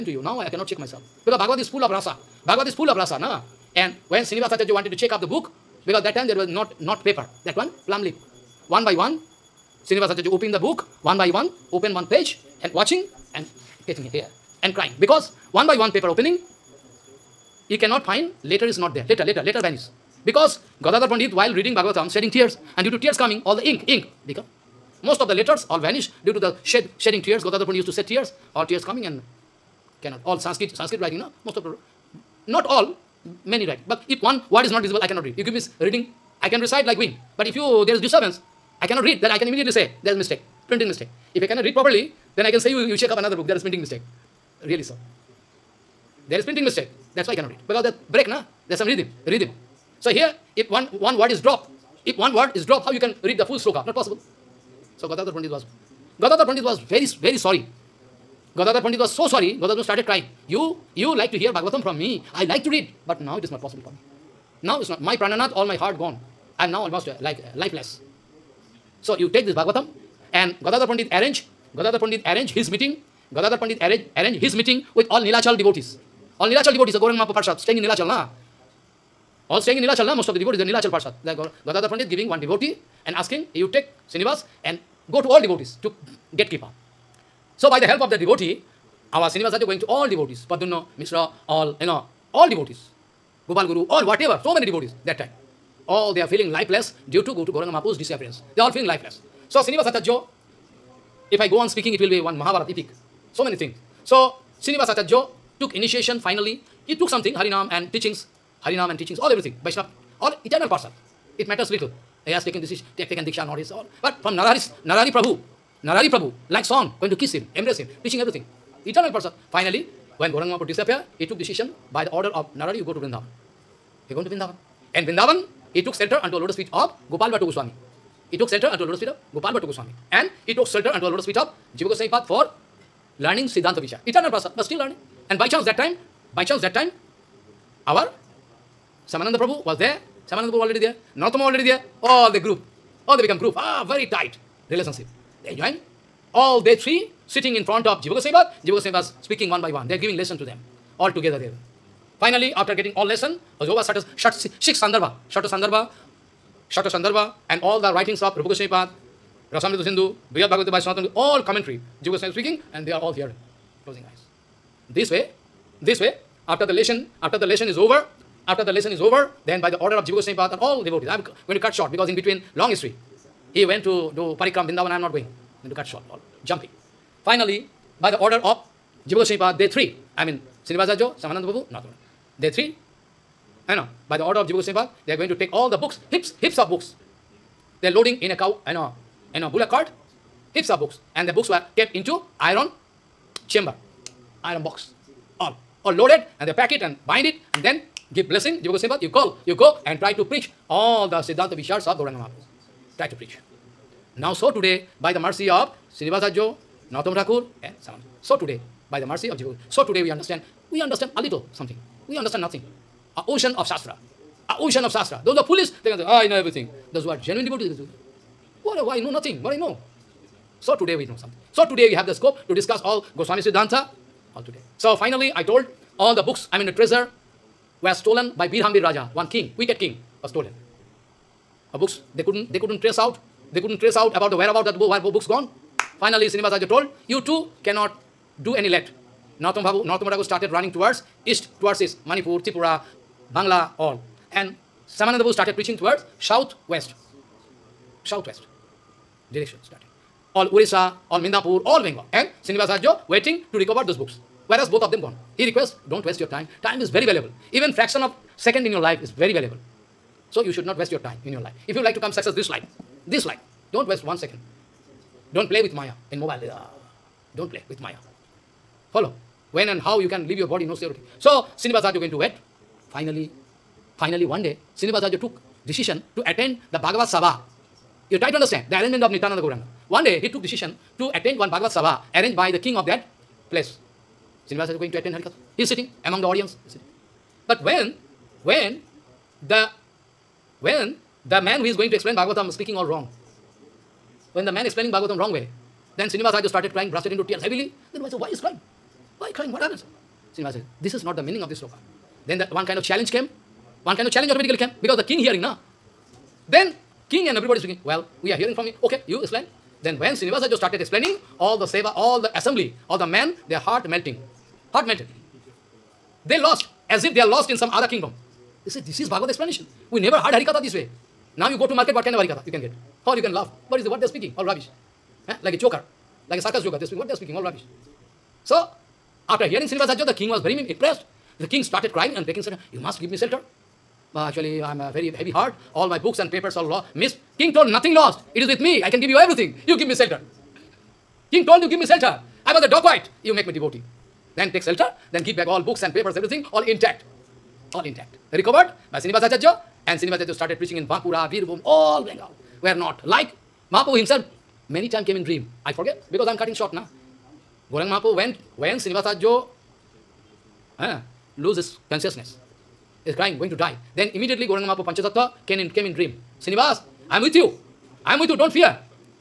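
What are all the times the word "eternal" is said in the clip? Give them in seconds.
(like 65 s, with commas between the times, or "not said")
110 s, 118 s, 134 s.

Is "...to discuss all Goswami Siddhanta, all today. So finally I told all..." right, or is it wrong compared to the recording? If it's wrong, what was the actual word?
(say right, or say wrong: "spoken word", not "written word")
right.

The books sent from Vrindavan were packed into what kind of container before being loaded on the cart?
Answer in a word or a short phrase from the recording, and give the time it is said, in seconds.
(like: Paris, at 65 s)
Iron box, at 194 s.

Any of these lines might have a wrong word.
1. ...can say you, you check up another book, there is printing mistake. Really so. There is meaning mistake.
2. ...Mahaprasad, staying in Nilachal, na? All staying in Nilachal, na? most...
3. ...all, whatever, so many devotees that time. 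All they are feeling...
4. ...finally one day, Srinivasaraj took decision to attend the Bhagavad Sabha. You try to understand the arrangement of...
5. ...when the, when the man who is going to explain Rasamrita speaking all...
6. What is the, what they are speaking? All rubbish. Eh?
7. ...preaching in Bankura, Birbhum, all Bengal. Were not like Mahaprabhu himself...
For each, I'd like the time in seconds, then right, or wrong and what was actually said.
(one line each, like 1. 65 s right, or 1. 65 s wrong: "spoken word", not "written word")
1. 42 s wrong: "printing", not "meaning"
2. 77 s right
3. 93 s right
4. 273 s right
5. 288 s wrong: "Bhagavatam", not "Rasamrita"
6. 323 s right
7. 350 s right.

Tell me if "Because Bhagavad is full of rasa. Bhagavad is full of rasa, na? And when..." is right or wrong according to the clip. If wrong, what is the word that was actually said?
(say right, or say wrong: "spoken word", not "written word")
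right.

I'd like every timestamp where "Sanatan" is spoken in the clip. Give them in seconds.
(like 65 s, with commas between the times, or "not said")
160 s.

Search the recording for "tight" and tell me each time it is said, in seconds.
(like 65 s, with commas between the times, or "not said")
144 s.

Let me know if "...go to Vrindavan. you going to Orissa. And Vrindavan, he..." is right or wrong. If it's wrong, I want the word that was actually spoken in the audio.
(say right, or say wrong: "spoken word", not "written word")
wrong: "Vrindavan", not "Orissa".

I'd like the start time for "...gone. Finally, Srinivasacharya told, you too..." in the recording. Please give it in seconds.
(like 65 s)
235 s.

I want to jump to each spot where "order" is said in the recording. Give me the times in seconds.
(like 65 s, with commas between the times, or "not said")
122 s, 169 s, 178 s, 184 s.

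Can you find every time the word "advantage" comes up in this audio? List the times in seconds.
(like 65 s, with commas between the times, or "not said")
not said.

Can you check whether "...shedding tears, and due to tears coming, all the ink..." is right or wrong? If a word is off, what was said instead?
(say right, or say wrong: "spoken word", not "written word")
right.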